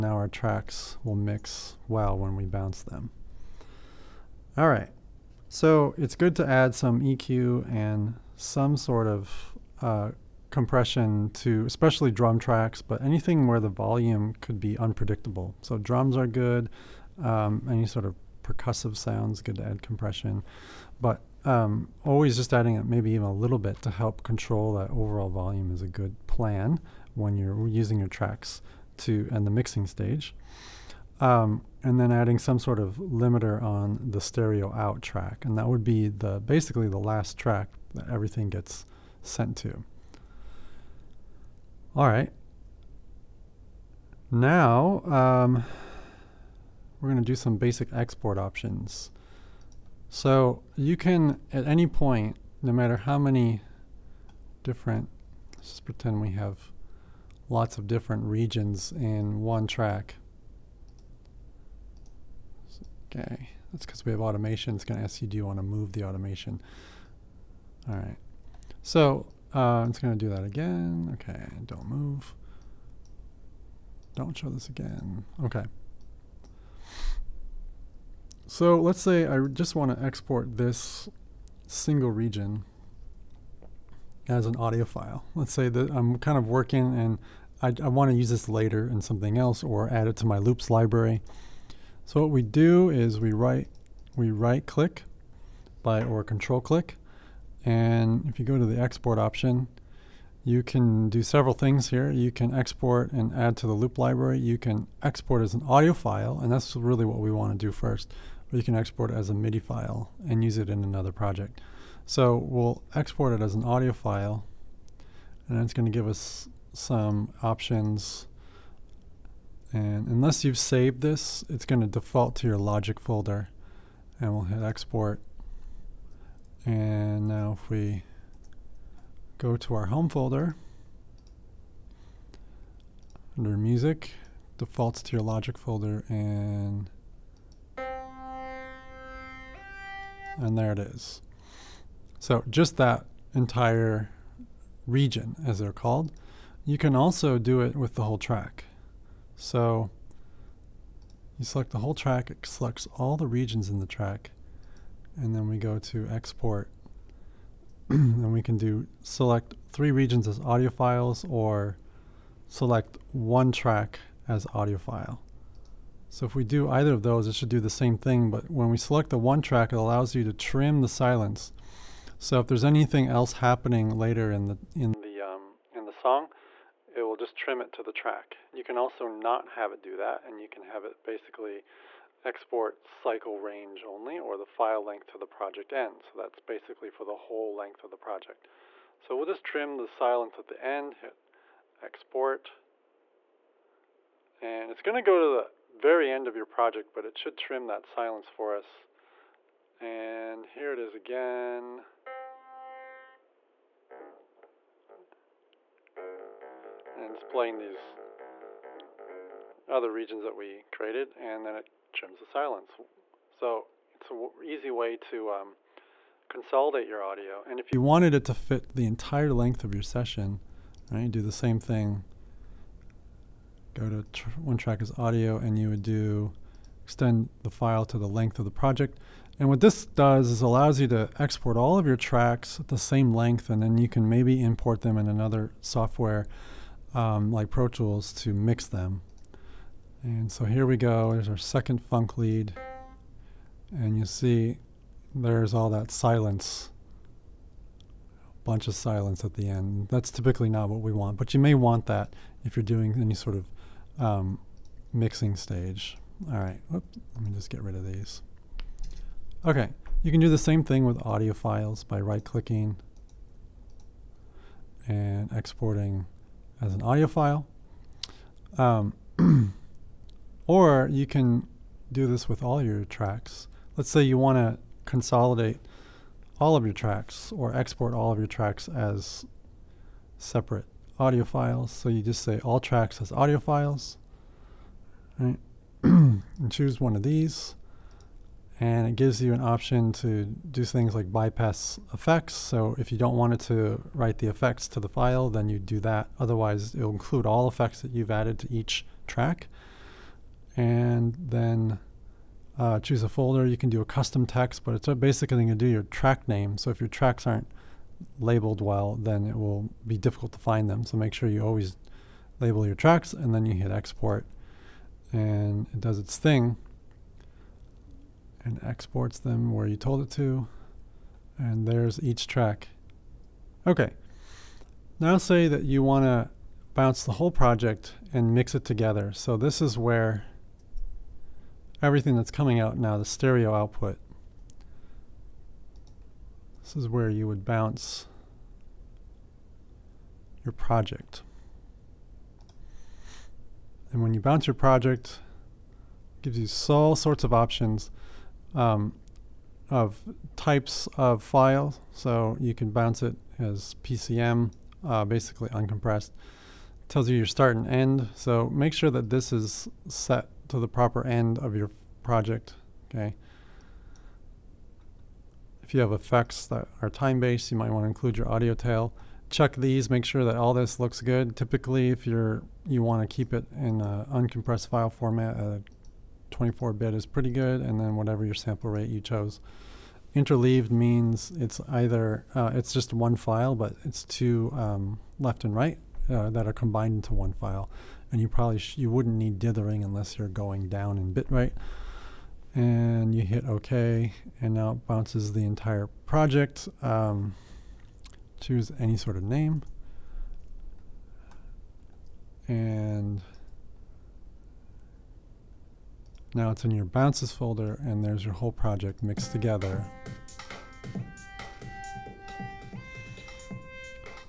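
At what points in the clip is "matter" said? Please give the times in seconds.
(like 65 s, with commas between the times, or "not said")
52 s.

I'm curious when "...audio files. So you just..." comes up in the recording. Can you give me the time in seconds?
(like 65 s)
281 s.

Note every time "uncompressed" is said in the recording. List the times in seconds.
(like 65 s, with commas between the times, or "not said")
355 s, 374 s.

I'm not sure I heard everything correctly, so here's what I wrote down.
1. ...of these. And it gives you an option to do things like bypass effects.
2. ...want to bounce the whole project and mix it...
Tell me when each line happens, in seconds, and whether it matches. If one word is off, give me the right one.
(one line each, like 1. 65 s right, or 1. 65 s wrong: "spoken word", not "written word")
1. 286 s right
2. 325 s right.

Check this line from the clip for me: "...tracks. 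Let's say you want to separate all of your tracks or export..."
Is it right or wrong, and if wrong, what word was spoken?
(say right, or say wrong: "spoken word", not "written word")
wrong: "consolidate", not "separate".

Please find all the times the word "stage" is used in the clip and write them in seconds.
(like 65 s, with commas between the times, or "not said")
29 s, 255 s.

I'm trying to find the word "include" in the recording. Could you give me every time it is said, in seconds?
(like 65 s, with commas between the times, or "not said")
296 s, 367 s.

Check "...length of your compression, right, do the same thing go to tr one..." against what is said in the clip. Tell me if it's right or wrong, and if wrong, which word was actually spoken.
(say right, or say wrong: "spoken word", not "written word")
wrong: "session", not "compression".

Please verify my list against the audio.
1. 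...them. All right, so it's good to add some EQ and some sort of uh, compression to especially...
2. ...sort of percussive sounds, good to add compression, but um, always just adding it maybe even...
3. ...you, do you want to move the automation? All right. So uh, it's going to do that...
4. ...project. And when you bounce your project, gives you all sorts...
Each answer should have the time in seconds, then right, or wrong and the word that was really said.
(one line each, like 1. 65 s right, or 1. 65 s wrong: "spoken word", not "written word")
1. 2 s right
2. 17 s right
3. 65 s right
4. 340 s right.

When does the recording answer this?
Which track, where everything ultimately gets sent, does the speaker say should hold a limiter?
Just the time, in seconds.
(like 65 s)
34 s.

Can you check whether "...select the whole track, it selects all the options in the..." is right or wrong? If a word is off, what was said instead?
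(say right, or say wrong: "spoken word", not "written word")
wrong: "regions", not "options".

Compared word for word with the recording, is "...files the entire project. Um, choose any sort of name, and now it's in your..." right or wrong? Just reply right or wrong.
wrong.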